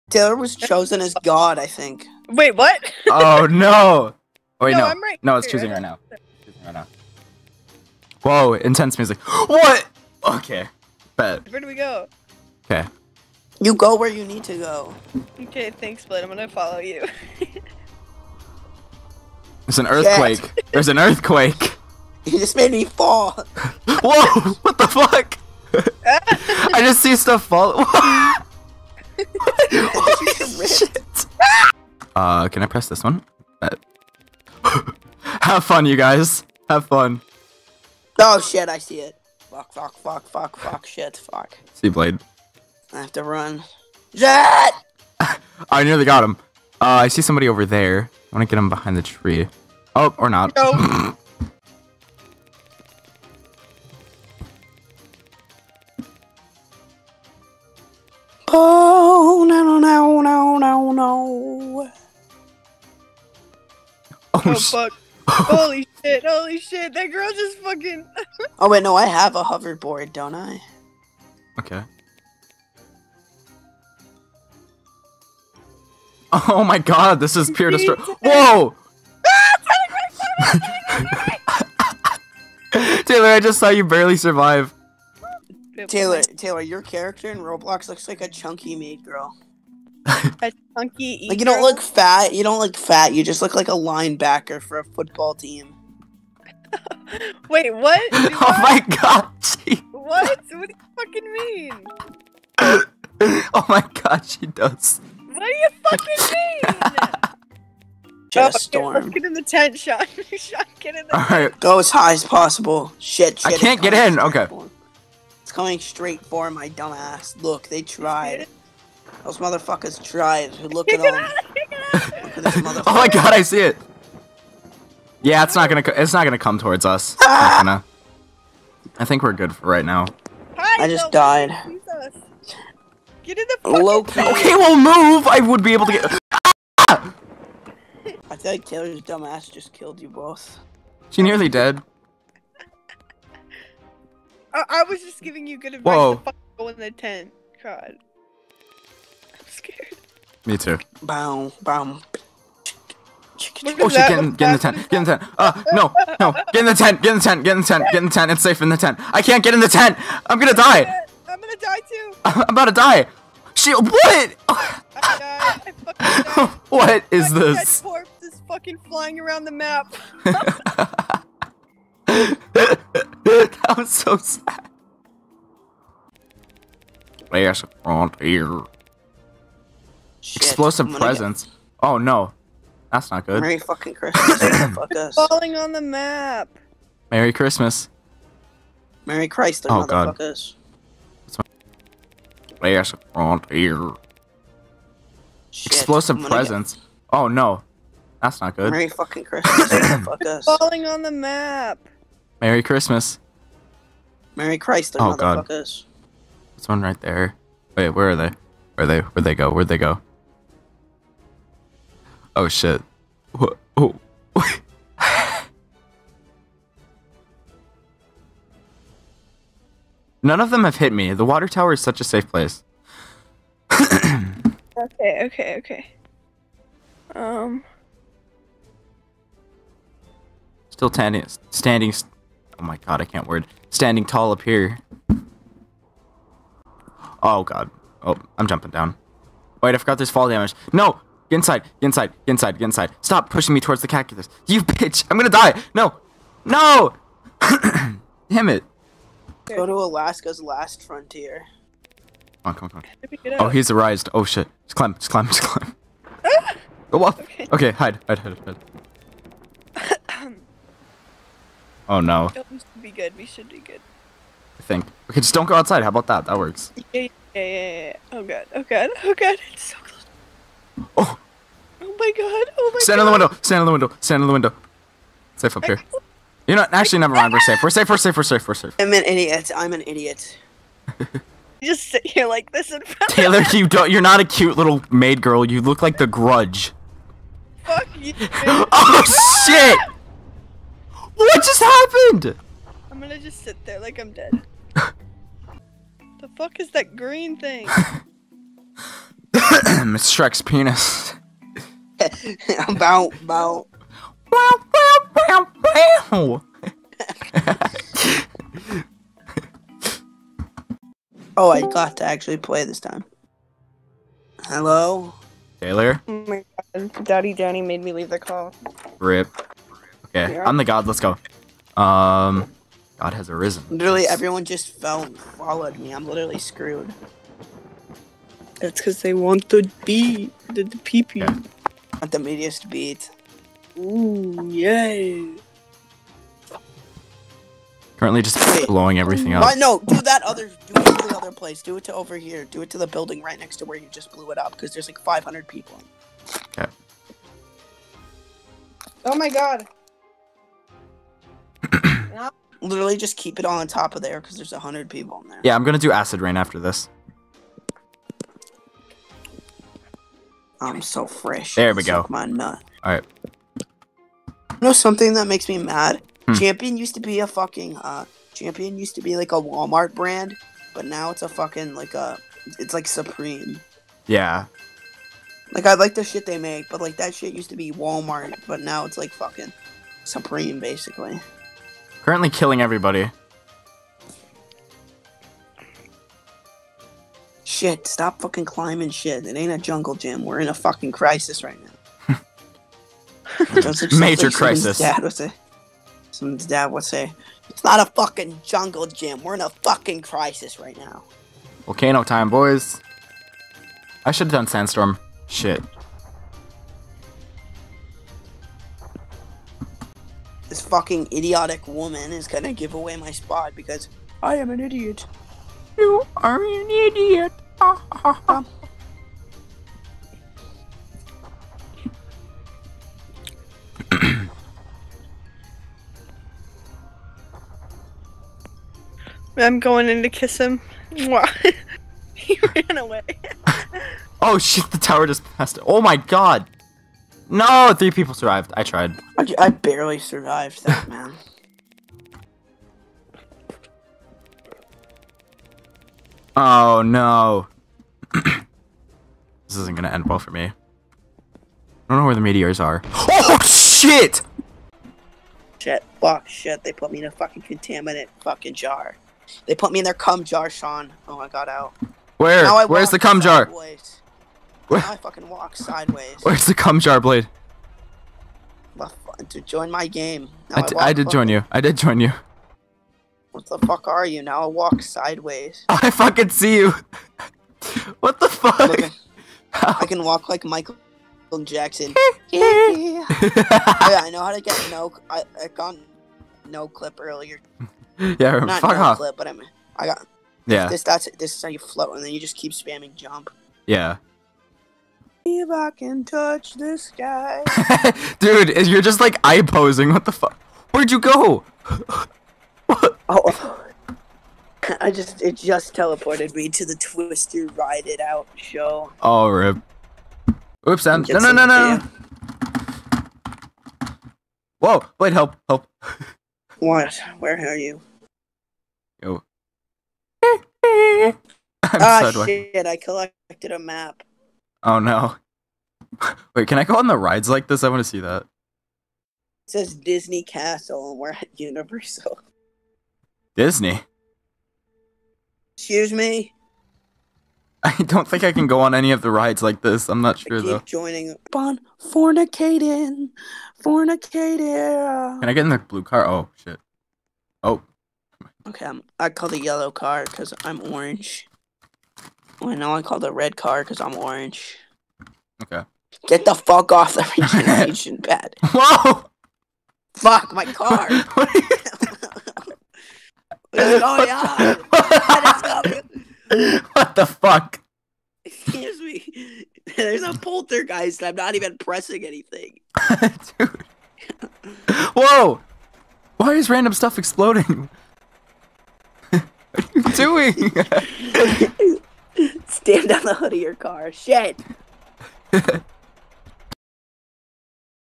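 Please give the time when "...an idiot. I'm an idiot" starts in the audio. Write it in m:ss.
4:38.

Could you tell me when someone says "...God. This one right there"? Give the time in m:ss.
3:25.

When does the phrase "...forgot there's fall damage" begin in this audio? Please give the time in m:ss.
3:59.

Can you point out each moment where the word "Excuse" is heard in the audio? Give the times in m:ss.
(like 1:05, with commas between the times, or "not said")
8:55, 9:28.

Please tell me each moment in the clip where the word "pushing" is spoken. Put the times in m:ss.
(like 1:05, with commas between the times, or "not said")
4:03.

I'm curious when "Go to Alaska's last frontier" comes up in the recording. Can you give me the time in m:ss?
4:09.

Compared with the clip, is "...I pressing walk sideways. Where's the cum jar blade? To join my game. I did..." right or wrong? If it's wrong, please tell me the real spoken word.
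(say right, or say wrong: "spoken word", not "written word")
wrong: "fucking", not "pressing".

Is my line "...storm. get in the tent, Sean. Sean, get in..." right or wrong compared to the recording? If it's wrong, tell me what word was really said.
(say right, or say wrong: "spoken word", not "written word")
right.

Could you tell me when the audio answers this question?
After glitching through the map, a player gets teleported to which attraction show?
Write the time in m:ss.
8:26.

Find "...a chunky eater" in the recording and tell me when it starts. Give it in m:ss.
1:30.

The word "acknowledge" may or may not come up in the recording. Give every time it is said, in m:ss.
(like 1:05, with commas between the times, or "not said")
not said.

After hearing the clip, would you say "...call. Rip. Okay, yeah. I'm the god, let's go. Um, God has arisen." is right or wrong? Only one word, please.
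right.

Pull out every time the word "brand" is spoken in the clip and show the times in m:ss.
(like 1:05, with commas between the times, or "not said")
6:09.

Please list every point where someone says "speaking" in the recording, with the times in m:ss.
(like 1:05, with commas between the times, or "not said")
not said.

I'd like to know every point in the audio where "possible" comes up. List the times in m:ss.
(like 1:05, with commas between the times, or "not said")
1:52.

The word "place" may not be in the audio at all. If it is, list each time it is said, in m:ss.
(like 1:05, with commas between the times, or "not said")
3:42, 5:41.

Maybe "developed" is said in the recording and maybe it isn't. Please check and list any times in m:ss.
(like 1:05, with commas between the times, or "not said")
not said.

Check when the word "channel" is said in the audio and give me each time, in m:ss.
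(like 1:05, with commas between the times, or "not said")
not said.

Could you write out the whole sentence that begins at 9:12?
Well, know I call the red car because I'm orange.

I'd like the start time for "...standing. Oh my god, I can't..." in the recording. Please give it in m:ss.
3:51.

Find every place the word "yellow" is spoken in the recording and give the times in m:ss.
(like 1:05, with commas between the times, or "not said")
9:09.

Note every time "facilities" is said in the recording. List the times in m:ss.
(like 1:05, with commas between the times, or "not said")
not said.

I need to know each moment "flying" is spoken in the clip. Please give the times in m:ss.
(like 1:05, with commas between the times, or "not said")
2:48.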